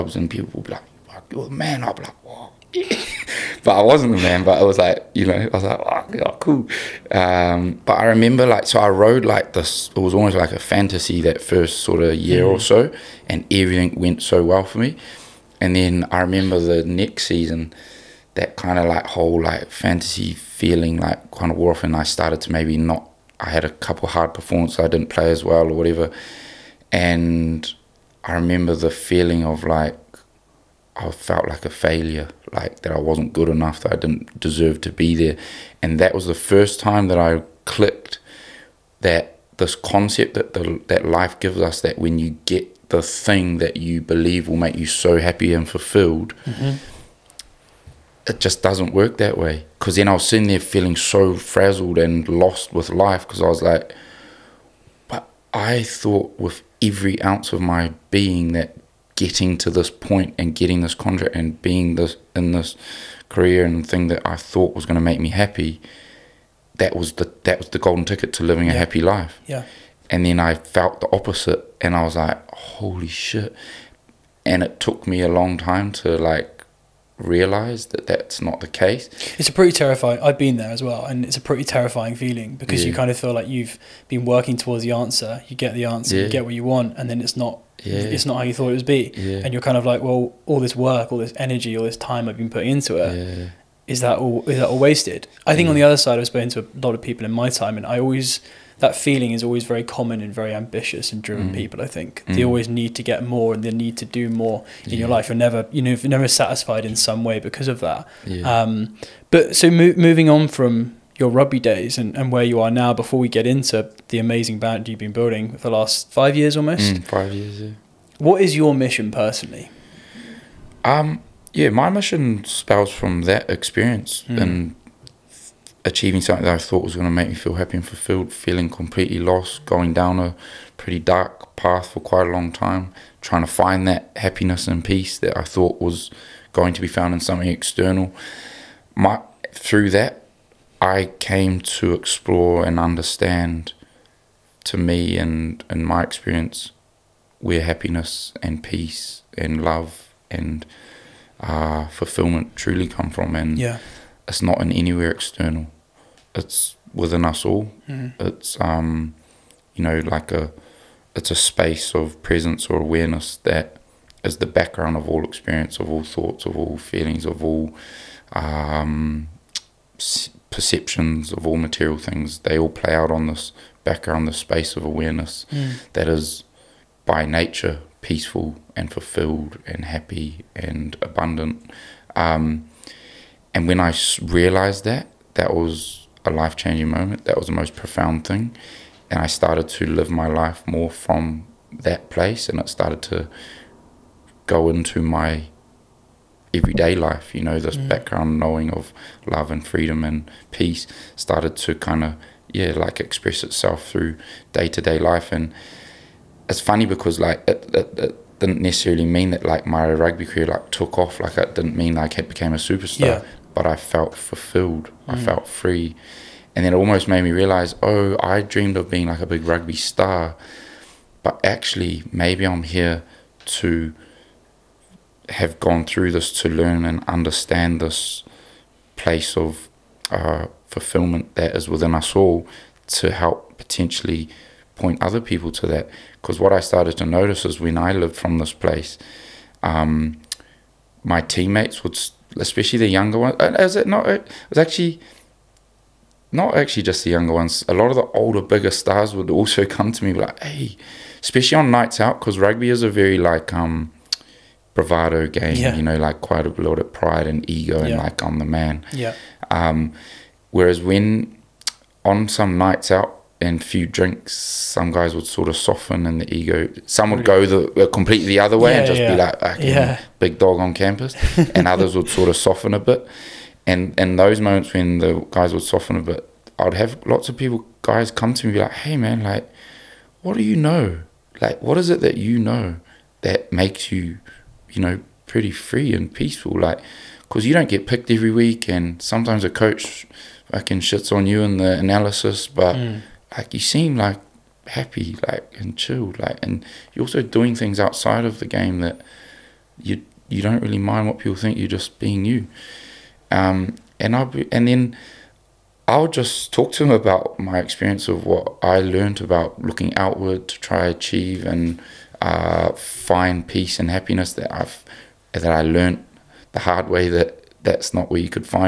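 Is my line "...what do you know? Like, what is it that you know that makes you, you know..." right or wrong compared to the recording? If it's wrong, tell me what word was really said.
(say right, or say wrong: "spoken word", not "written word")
right.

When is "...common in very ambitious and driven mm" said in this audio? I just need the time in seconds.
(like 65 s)
99 s.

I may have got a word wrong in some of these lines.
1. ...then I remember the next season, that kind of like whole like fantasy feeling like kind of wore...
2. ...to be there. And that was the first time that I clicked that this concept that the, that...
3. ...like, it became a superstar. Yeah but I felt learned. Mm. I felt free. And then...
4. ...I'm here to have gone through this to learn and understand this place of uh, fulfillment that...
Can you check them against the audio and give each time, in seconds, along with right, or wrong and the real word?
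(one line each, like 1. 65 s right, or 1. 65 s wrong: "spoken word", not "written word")
1. 15 s right
2. 34 s right
3. 211 s wrong: "fulfilled", not "learned"
4. 222 s right.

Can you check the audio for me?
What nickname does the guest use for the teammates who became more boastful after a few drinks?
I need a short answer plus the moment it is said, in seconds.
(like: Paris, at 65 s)
big dog on campus, at 270 s.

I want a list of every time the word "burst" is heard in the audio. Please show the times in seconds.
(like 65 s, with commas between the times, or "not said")
not said.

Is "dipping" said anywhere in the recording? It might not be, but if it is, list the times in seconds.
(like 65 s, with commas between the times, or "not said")
not said.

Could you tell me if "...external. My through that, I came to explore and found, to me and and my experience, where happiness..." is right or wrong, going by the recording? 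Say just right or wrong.
wrong.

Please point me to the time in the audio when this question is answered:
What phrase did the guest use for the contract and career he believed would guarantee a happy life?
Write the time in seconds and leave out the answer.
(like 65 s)
67 s.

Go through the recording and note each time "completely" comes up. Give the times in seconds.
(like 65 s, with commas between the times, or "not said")
128 s, 267 s.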